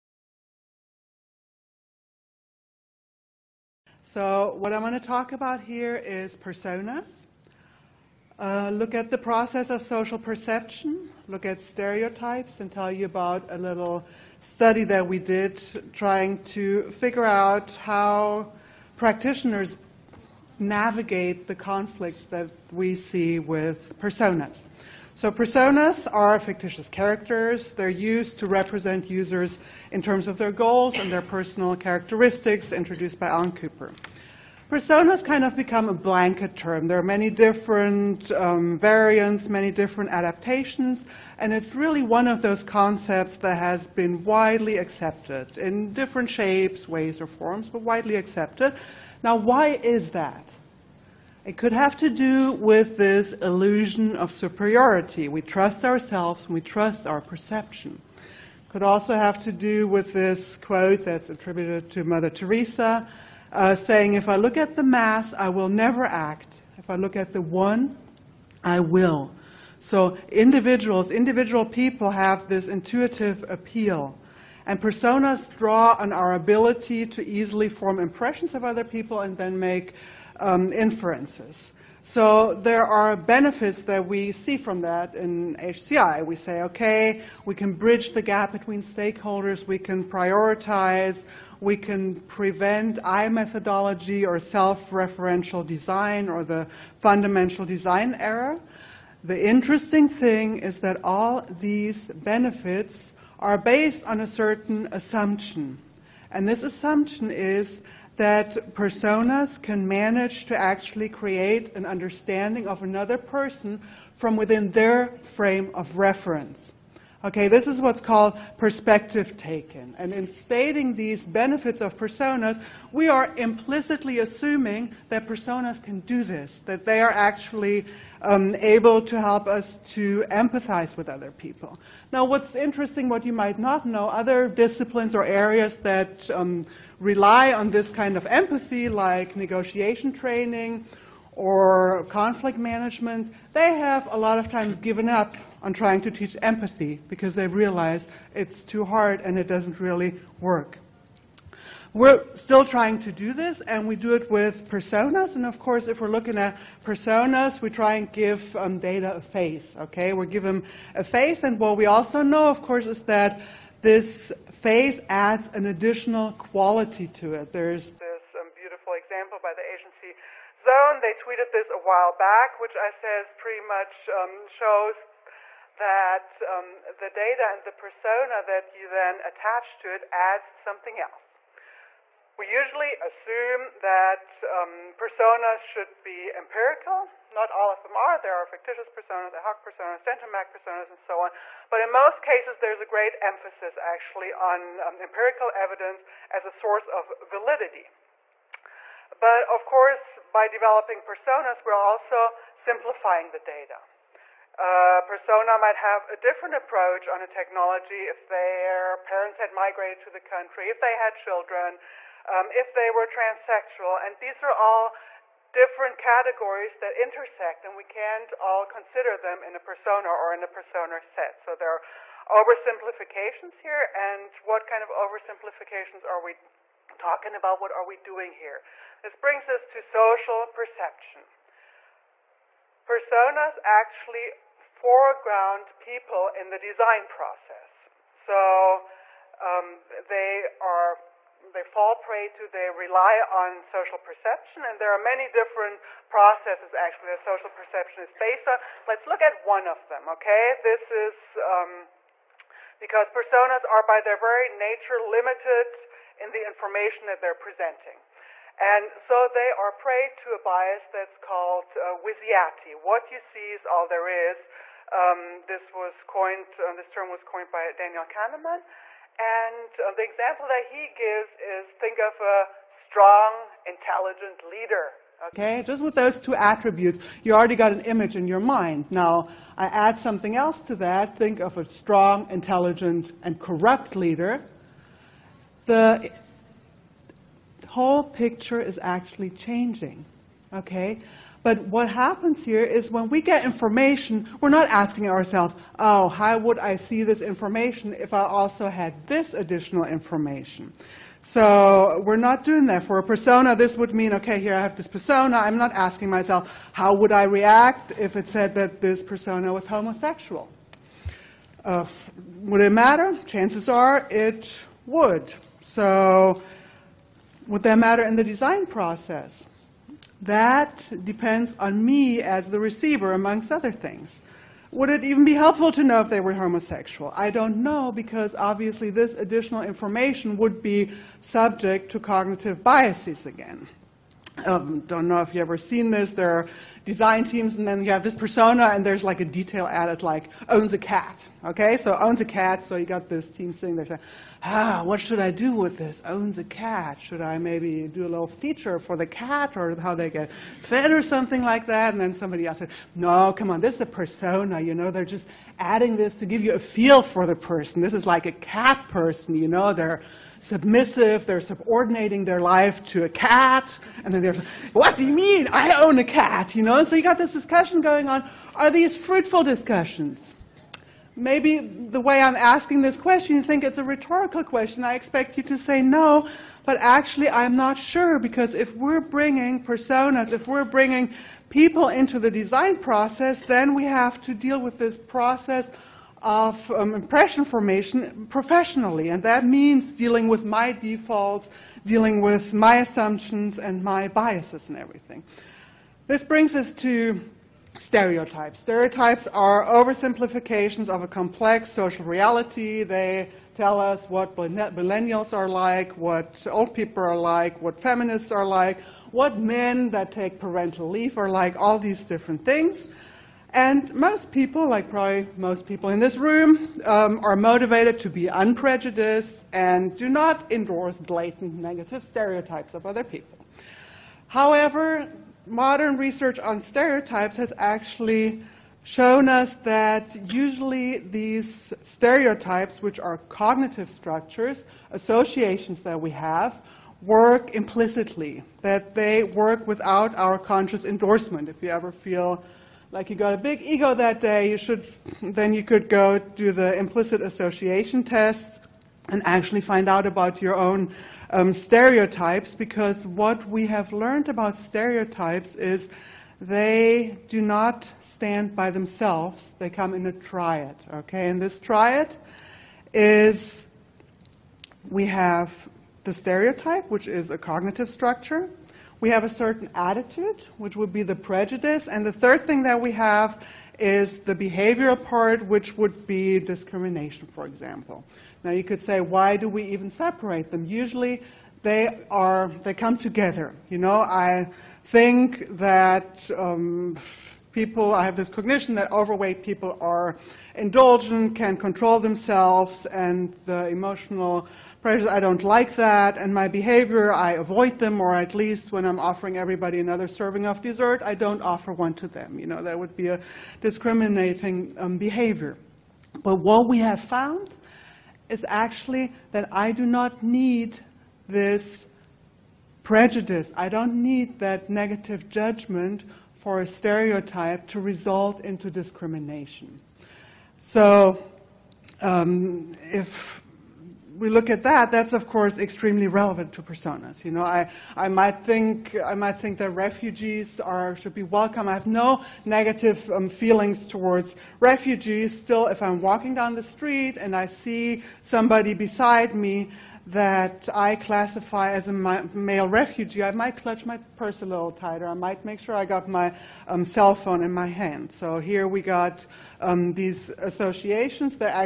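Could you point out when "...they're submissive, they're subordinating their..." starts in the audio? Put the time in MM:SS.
05:59.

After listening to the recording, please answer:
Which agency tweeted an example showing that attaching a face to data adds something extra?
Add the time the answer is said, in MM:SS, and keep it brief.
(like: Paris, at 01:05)
Zone, at 02:50.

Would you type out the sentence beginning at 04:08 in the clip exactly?
Let's look at one of them, okay?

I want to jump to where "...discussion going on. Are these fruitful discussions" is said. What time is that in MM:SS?
06:07.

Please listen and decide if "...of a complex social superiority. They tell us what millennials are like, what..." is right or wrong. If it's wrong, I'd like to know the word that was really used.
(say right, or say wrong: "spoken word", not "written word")
wrong: "reality", not "superiority".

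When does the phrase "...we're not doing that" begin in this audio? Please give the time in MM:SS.
05:02.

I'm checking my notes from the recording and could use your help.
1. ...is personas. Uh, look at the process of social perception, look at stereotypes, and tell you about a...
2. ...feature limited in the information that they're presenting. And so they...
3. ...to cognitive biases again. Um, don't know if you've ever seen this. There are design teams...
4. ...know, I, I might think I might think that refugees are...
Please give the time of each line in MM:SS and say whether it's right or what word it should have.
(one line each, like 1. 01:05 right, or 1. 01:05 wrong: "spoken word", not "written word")
1. 00:05 right
2. 04:14 wrong: "nature", not "feature"
3. 05:31 right
4. 08:47 right.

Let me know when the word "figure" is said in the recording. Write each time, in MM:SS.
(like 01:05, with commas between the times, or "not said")
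00:16.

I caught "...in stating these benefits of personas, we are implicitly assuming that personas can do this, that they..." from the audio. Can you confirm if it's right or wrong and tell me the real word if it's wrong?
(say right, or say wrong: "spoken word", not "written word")
right.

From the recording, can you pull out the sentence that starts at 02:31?
We're still trying to do this, and we do it with personas.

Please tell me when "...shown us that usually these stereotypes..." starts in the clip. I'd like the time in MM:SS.
07:08.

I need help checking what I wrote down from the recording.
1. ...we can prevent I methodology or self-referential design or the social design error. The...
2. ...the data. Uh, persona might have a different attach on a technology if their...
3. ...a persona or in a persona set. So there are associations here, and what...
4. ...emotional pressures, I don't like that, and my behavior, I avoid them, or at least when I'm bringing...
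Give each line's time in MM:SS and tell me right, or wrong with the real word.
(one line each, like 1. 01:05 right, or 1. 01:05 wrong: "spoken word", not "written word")
1. 01:31 wrong: "fundamental", not "social"
2. 03:23 wrong: "approach", not "attach"
3. 03:39 wrong: "oversimplifications", not "associations"
4. 08:13 wrong: "offering", not "bringing".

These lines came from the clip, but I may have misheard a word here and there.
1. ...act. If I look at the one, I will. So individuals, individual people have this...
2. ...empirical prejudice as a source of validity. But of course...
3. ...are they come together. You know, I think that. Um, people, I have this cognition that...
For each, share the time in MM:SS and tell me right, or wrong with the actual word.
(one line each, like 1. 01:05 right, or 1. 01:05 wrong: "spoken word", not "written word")
1. 01:06 right
2. 03:14 wrong: "evidence", not "prejudice"
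3. 08:02 right.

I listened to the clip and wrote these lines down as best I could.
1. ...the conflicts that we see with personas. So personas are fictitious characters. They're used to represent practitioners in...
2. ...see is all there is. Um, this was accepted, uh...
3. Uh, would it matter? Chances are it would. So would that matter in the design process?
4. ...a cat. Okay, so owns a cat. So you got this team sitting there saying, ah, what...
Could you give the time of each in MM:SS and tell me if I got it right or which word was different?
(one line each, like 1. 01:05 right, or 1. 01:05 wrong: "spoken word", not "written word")
1. 00:21 wrong: "users", not "practitioners"
2. 04:23 wrong: "coined", not "accepted"
3. 05:11 right
4. 05:40 right.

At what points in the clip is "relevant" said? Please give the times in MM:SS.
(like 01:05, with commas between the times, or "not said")
08:46.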